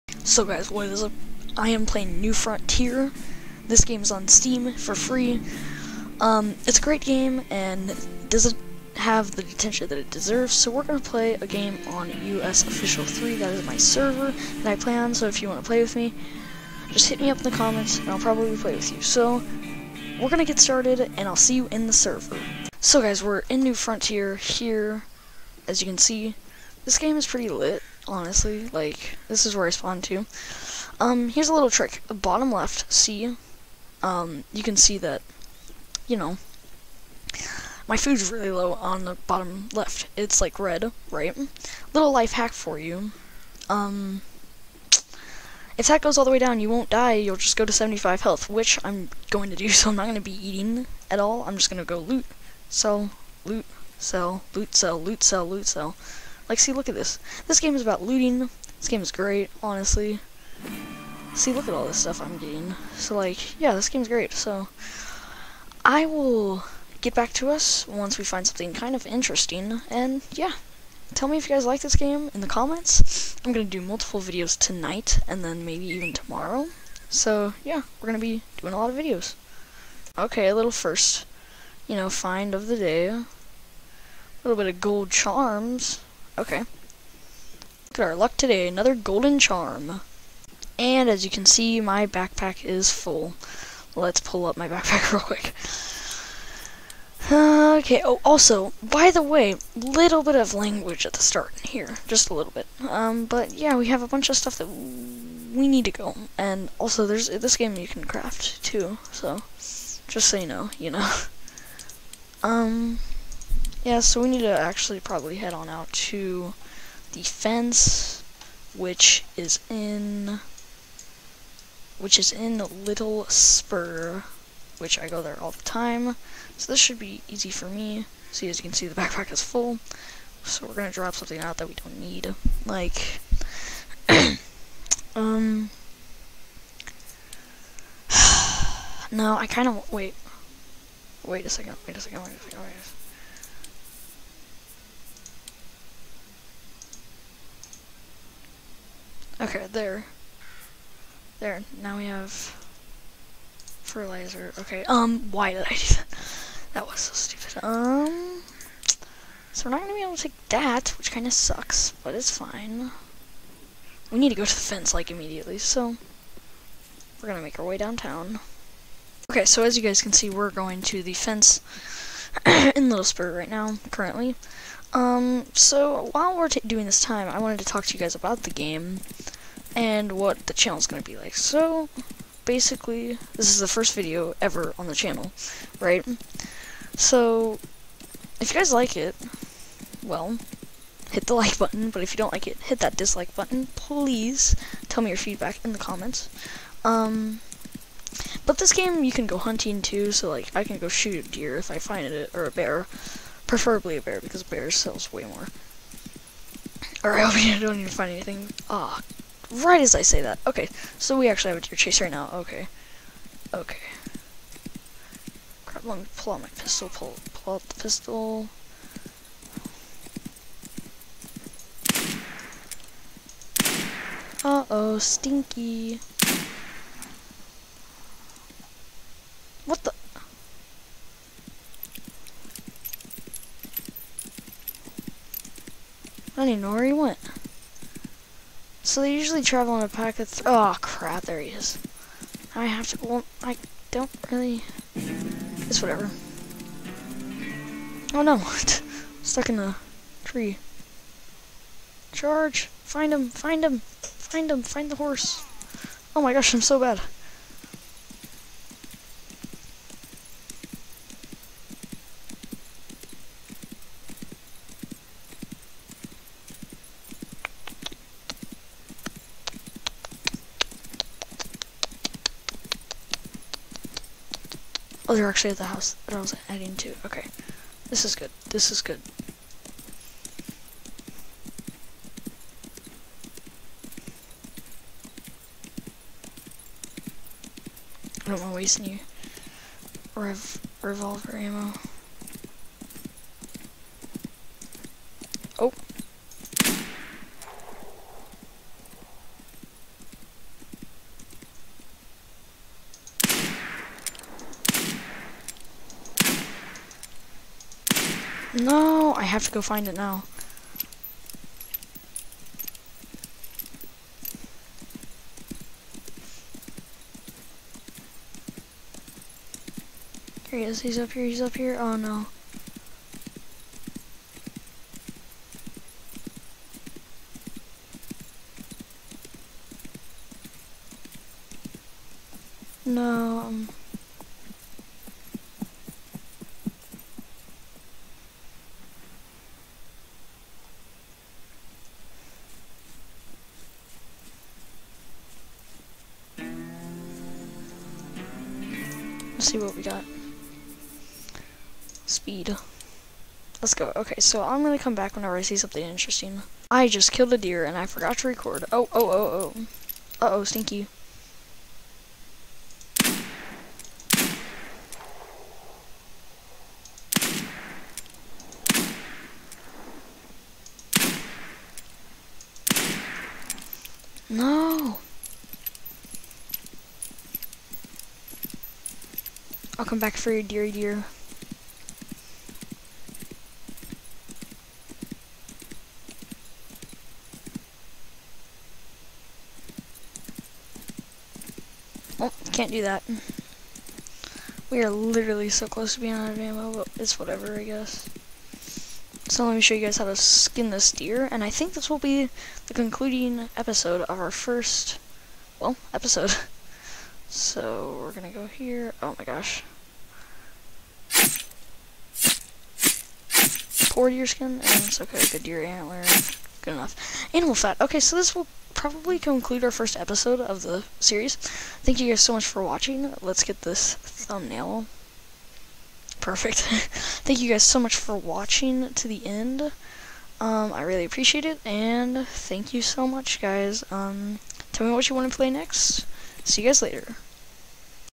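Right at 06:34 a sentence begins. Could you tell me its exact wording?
We are literally so close to being out of ammo, but it's whatever, I guess.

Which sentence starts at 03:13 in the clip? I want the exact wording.
Please tell me your feedback in the comments.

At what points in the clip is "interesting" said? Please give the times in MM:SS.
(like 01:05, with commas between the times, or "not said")
01:09, 05:55.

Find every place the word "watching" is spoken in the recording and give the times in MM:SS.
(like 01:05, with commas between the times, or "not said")
07:02, 07:08.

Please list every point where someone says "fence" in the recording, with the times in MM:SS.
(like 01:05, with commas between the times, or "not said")
01:57, 02:44, 02:51.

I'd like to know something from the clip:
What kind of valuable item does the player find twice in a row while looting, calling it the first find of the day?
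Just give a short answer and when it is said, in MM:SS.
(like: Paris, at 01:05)
Gold charms, at 01:24.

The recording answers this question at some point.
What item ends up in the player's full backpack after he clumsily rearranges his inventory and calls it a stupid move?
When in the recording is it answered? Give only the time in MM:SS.
02:33.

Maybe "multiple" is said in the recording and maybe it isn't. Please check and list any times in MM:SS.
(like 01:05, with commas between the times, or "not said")
01:13.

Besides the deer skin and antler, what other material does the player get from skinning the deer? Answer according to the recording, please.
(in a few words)
Animal fat.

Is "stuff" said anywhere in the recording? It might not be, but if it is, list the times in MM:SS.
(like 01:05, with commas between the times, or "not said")
01:01, 01:44.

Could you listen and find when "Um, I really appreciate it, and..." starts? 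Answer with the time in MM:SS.
07:10.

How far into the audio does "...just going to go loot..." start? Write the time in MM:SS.
00:51.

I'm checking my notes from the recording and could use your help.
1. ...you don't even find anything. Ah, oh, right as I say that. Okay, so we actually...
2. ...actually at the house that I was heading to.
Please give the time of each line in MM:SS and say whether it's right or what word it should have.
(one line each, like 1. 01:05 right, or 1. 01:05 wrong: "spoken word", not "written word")
1. 03:27 right
2. 04:35 right.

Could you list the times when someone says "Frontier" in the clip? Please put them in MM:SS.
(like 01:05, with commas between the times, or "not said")
00:02, 00:23.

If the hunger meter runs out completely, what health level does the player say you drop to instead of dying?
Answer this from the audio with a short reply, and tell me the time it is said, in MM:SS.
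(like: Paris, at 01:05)
75, at 00:47.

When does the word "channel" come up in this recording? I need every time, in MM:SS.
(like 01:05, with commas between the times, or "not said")
03:00, 03:04.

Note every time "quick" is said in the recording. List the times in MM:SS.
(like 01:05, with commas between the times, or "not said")
01:35.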